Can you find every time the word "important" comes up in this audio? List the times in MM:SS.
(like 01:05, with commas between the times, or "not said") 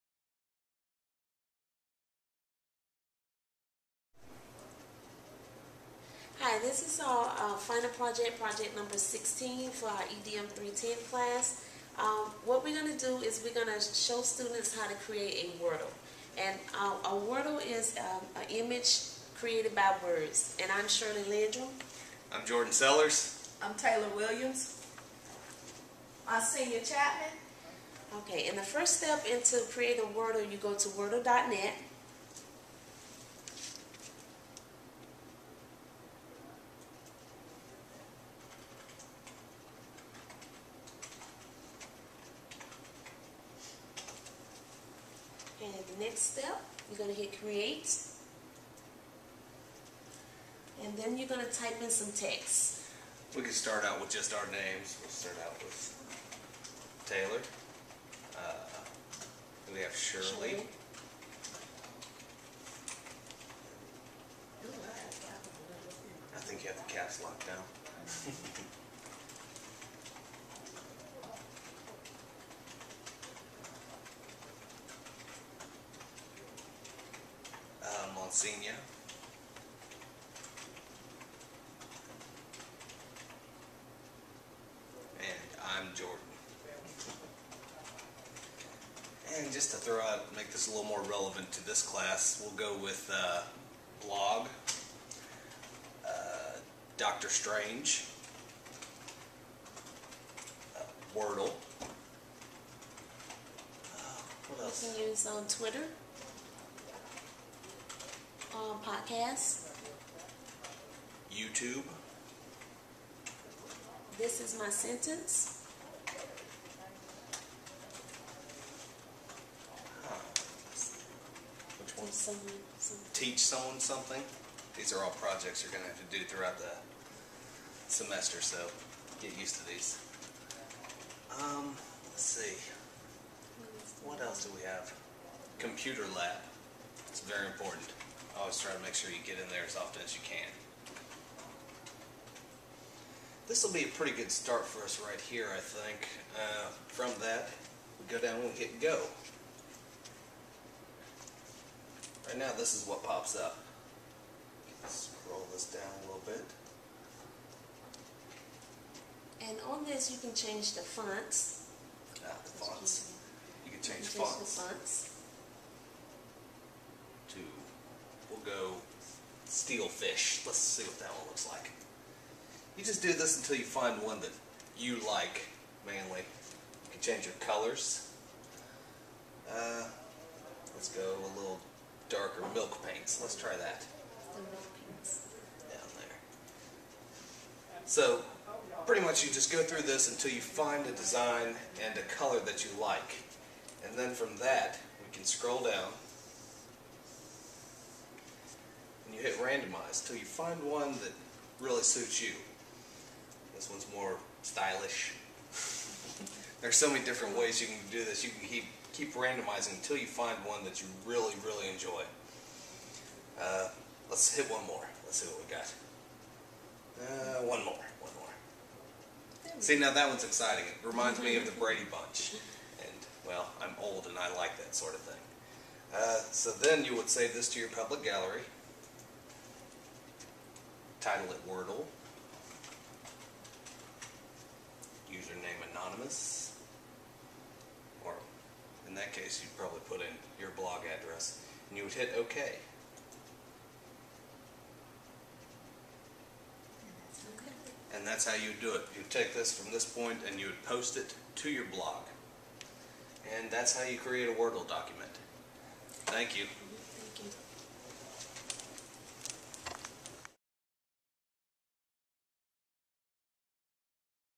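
02:17.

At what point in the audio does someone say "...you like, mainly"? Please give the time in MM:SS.
02:54.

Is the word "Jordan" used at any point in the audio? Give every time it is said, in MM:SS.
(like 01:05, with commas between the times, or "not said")
00:22, 01:25.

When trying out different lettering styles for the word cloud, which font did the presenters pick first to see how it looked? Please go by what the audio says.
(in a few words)
Steelfish.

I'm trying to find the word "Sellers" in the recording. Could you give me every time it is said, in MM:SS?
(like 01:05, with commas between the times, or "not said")
00:22.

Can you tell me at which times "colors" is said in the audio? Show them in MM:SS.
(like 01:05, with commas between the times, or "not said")
02:57, 03:12.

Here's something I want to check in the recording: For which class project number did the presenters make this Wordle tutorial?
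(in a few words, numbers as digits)
16.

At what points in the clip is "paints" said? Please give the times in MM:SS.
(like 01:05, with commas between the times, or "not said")
03:02.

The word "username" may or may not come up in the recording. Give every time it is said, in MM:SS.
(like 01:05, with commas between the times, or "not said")
03:55.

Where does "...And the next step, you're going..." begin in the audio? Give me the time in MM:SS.
00:45.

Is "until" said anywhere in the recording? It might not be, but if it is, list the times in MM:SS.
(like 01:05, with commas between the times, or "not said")
02:53, 03:10, 03:29.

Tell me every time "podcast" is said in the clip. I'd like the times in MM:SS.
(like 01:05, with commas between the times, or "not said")
01:49.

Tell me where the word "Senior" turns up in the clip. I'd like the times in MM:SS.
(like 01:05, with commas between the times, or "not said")
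00:26, 01:18.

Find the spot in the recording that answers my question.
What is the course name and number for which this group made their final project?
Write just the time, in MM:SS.
00:10.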